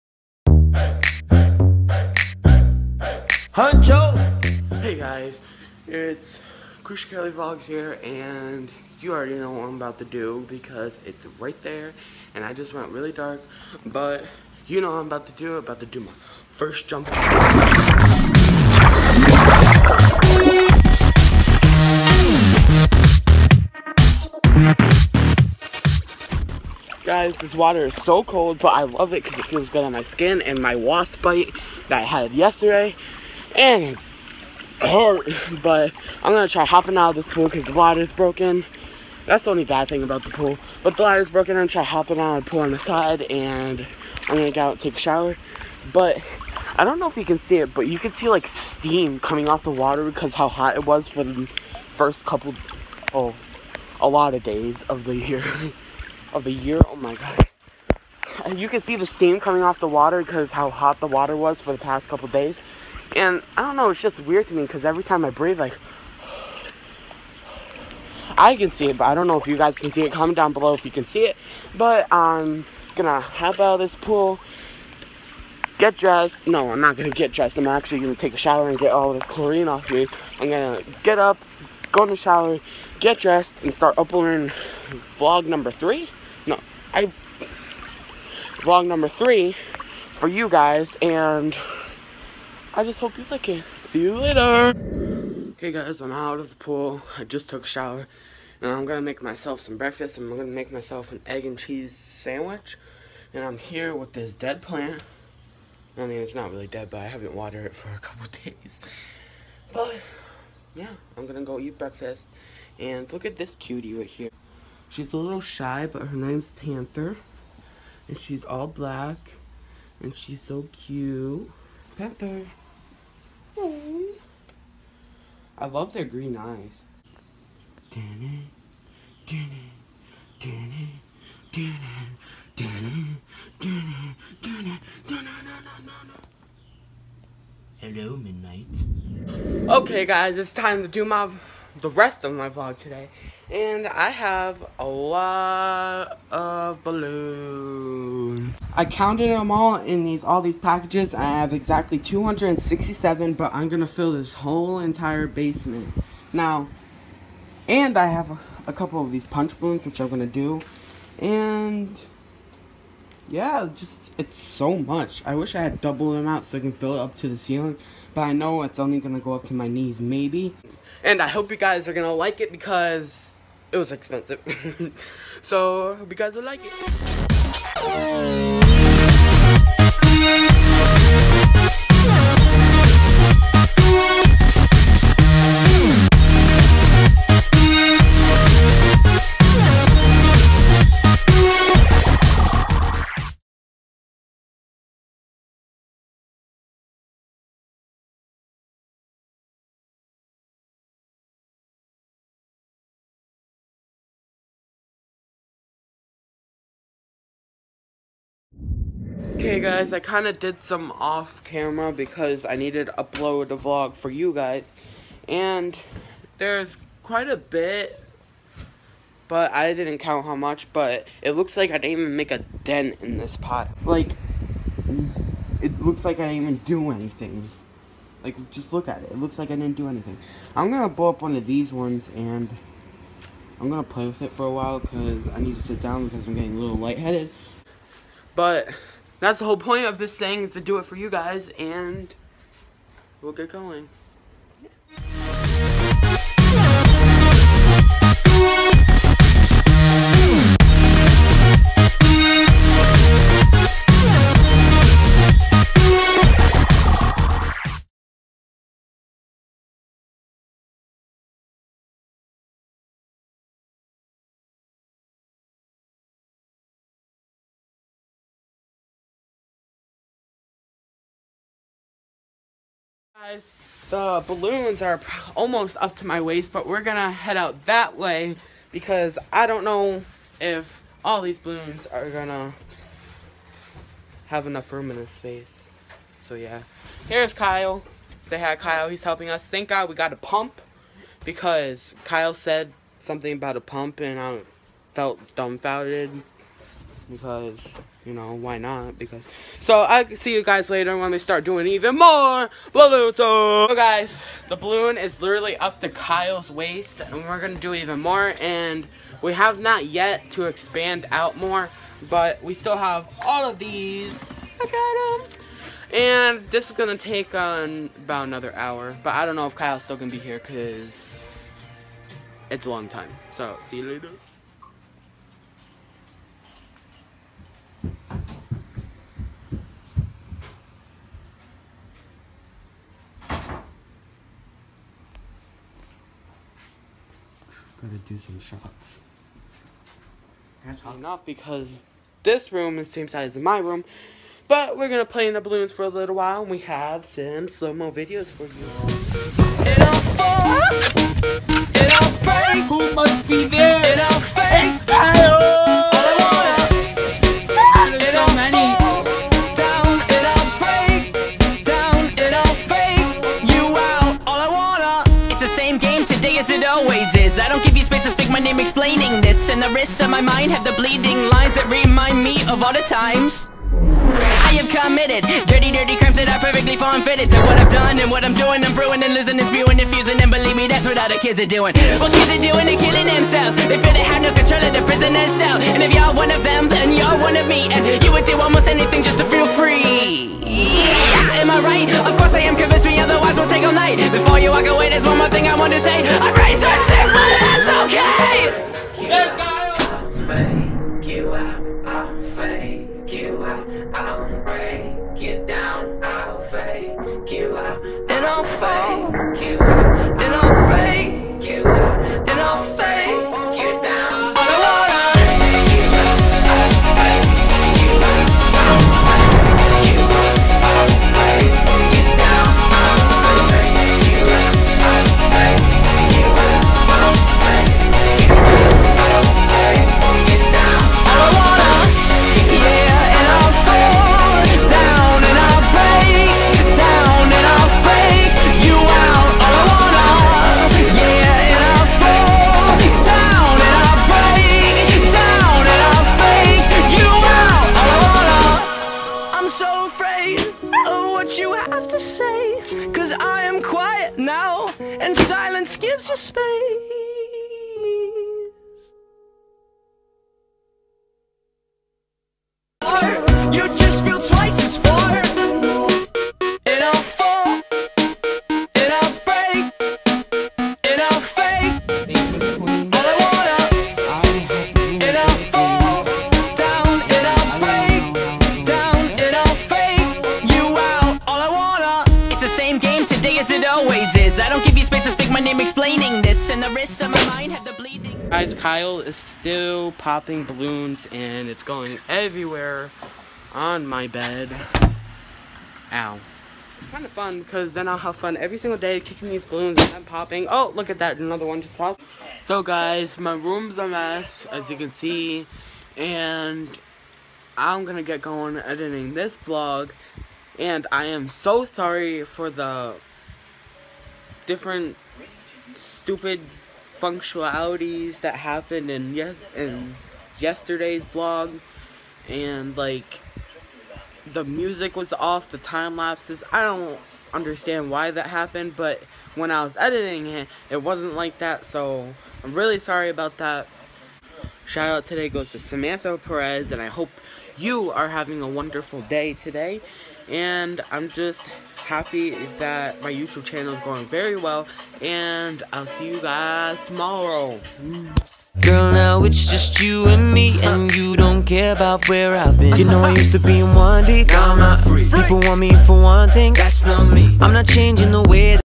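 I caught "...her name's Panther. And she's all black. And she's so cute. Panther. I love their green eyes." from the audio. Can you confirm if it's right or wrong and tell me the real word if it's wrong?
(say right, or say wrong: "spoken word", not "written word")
right.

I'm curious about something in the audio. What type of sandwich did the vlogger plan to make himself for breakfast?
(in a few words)
Egg and cheese.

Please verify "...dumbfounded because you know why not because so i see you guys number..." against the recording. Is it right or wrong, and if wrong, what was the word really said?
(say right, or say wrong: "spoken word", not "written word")
wrong: "later", not "number".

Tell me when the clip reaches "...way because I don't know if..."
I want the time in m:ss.
4:37.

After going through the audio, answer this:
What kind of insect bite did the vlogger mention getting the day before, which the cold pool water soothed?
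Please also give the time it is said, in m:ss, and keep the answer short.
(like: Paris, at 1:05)
Wasp bite, at 0:30.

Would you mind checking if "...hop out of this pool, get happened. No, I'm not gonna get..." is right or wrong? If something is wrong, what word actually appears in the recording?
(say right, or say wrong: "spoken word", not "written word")
wrong: "dressed", not "happened".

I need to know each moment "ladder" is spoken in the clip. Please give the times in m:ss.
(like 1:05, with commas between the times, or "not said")
0:41.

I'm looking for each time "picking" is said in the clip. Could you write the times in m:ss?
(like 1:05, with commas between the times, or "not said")
not said.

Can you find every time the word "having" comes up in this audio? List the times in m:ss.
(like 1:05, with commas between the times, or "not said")
8:58.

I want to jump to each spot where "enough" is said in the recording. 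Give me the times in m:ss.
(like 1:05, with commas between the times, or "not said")
4:44, 5:40.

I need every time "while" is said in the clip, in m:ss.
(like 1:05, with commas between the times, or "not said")
3:54, 5:46.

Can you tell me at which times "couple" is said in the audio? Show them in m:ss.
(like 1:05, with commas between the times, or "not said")
0:52, 1:02, 1:47, 2:38.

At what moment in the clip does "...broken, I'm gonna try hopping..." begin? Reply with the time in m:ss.
0:41.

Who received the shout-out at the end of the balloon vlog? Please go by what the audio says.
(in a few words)
Samantha Perez.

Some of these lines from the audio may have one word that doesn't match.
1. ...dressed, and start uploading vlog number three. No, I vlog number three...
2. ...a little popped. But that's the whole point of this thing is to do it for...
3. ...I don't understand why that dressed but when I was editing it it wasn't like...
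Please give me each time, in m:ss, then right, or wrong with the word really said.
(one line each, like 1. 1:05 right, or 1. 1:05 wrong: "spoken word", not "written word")
1. 1:23 right
2. 3:56 wrong: "lightheaded", not "popped"
3. 8:46 wrong: "happened", not "dressed".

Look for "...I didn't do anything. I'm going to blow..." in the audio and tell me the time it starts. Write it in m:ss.
3:49.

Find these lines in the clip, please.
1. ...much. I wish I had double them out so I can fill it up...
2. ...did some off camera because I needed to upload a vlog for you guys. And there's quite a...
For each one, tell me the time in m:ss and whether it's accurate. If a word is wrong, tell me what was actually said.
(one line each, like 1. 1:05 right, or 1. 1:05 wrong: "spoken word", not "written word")
1. 2:44 right
2. 3:30 right.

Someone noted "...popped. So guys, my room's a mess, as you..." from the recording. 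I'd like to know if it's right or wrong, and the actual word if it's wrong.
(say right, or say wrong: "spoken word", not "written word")
right.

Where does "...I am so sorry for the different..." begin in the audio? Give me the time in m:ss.
8:30.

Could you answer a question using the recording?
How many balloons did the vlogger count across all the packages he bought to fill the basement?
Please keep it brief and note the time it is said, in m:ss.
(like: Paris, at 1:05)
267, at 2:31.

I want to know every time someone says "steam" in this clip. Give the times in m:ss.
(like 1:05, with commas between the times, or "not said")
0:48, 0:59.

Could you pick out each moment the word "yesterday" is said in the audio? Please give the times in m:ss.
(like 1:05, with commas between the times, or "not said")
0:32, 8:40.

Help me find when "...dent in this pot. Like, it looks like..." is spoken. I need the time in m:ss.
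3:42.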